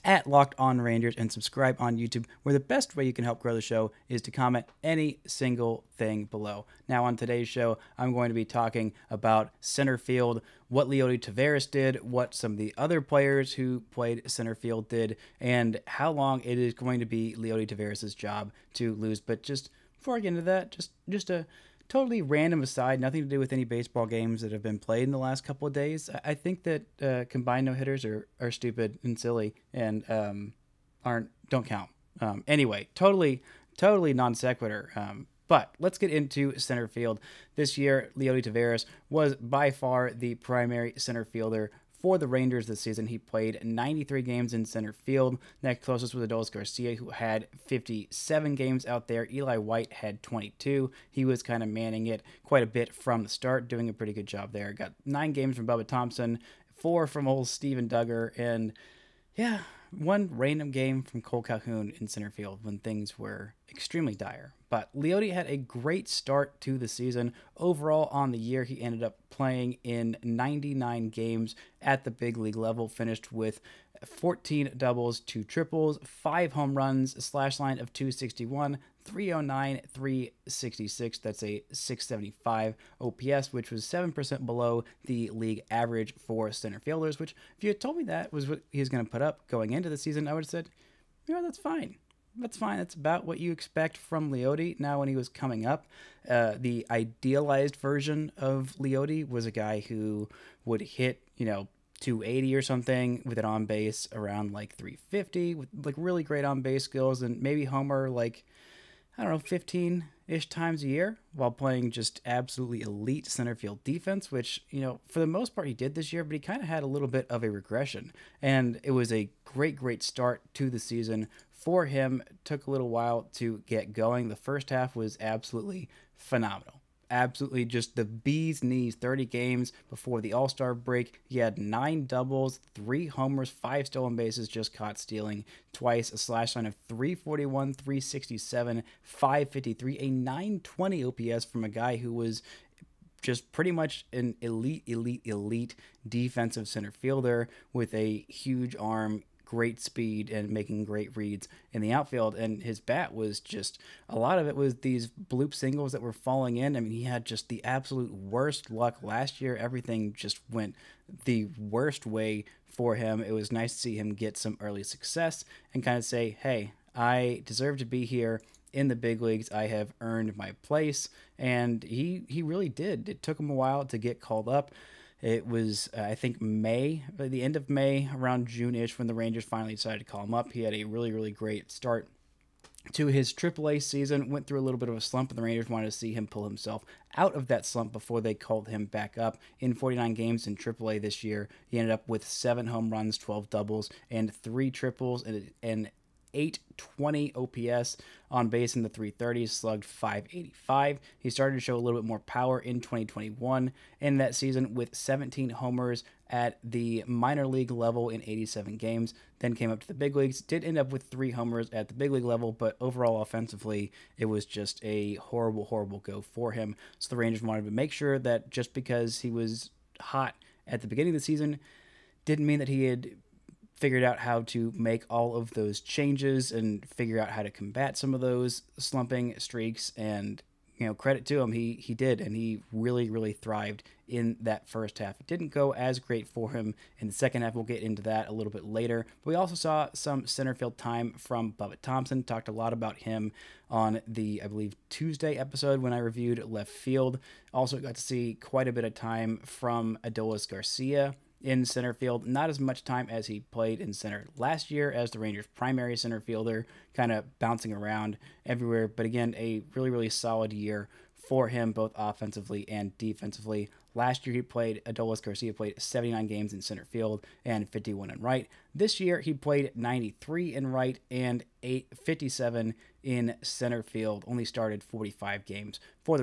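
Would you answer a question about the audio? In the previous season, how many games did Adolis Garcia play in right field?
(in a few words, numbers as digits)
51.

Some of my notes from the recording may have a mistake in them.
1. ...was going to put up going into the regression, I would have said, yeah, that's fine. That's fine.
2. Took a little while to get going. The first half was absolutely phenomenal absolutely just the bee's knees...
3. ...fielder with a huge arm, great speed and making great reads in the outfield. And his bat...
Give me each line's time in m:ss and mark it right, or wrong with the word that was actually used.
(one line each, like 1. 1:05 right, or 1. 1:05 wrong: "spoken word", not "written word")
1. 1:28 wrong: "season", not "regression"
2. 2:02 right
3. 2:26 right.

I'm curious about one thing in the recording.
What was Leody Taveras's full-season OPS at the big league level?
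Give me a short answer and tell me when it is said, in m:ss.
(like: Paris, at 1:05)
.675, at 1:21.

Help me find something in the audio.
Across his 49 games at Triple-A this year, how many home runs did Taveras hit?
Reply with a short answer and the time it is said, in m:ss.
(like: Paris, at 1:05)
7, at 3:12.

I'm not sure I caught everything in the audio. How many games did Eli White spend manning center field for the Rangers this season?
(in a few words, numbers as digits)
22.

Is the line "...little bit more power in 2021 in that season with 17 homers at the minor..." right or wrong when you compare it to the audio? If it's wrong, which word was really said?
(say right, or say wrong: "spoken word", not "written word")
right.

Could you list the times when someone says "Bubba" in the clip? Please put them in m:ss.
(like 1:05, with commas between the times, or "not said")
0:55, 4:01.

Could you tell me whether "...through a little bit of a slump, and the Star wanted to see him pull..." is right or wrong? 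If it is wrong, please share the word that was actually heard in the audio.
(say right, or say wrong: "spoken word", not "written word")
wrong: "Rangers", not "Star".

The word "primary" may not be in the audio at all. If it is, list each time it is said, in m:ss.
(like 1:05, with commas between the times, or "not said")
0:40, 4:15.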